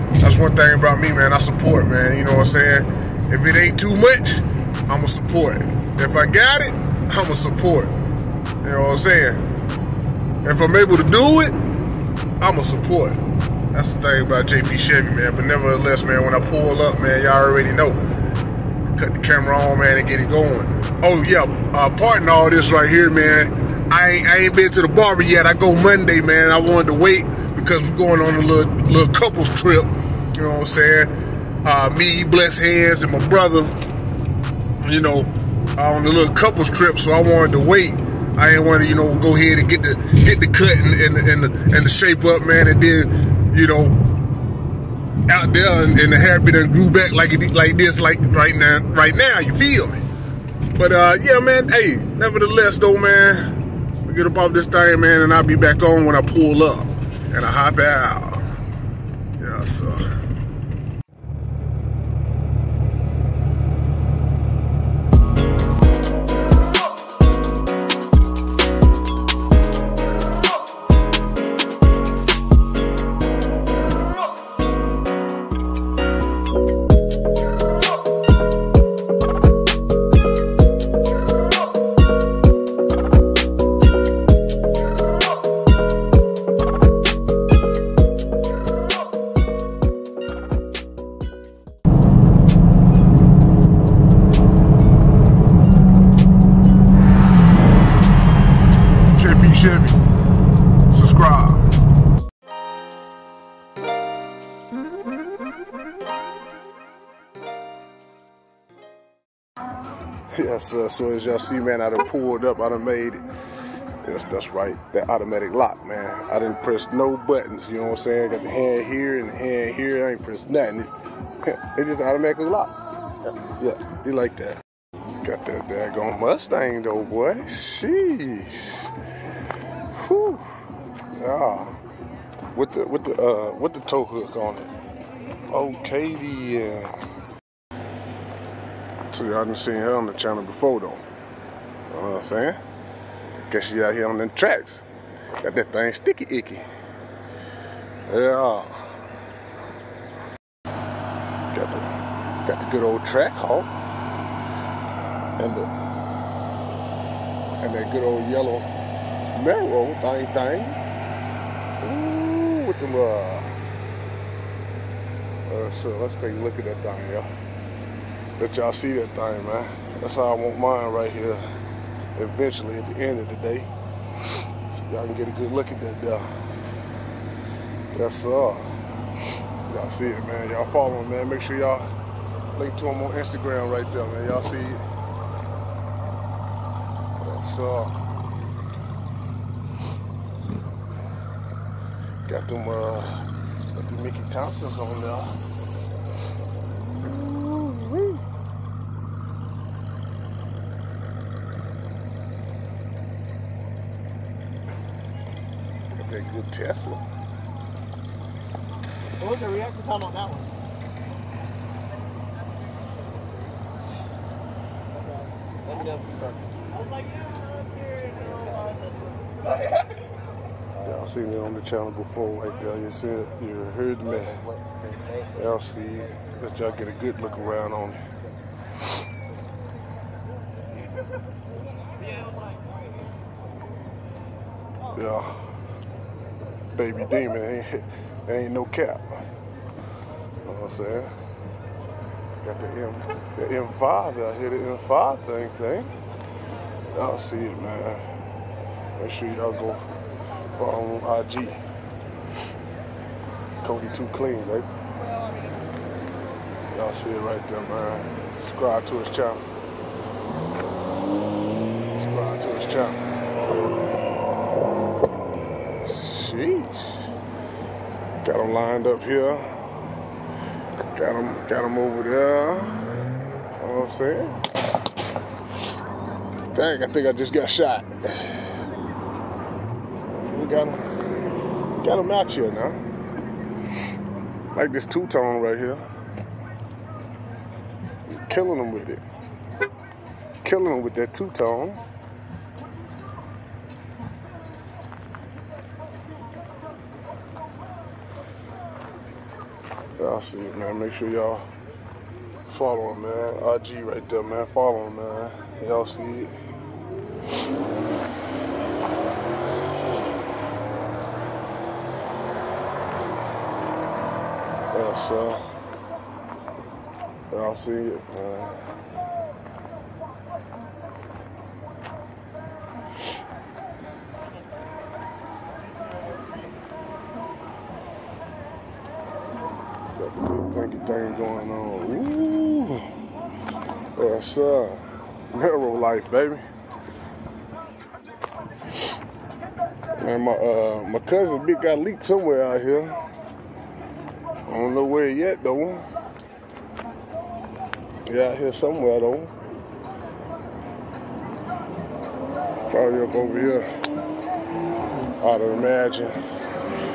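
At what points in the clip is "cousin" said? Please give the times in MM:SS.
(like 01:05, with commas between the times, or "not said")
05:40.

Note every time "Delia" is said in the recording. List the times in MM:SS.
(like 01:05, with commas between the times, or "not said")
03:42.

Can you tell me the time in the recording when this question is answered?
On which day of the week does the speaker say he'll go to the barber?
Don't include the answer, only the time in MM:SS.
00:25.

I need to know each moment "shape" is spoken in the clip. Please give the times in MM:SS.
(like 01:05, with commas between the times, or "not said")
00:41.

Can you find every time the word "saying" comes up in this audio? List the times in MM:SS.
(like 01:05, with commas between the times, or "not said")
00:02, 00:08, 00:30, 01:58, 02:22, 04:00, 04:36.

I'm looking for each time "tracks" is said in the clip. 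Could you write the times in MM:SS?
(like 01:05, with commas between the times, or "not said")
02:24, 02:33.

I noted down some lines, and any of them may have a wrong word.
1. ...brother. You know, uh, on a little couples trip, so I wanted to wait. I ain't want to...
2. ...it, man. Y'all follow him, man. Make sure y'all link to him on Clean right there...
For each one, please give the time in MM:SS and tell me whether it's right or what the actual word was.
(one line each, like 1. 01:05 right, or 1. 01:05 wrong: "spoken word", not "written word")
1. 00:33 right
2. 03:00 wrong: "Instagram", not "Clean".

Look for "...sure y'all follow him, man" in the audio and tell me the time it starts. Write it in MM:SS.
05:00.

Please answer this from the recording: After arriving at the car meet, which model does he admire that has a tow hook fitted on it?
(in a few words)
Mustang.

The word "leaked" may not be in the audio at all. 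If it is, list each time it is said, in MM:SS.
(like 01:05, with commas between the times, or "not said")
05:41.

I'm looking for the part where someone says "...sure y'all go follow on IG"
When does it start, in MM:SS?
04:09.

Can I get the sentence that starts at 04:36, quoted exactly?
Dang, I think I just got shot.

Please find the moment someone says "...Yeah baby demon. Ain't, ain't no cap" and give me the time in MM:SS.
03:54.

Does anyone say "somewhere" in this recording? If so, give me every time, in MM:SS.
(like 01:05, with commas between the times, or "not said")
05:42, 05:48.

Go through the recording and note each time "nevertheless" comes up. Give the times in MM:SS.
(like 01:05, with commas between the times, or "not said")
00:15, 00:52.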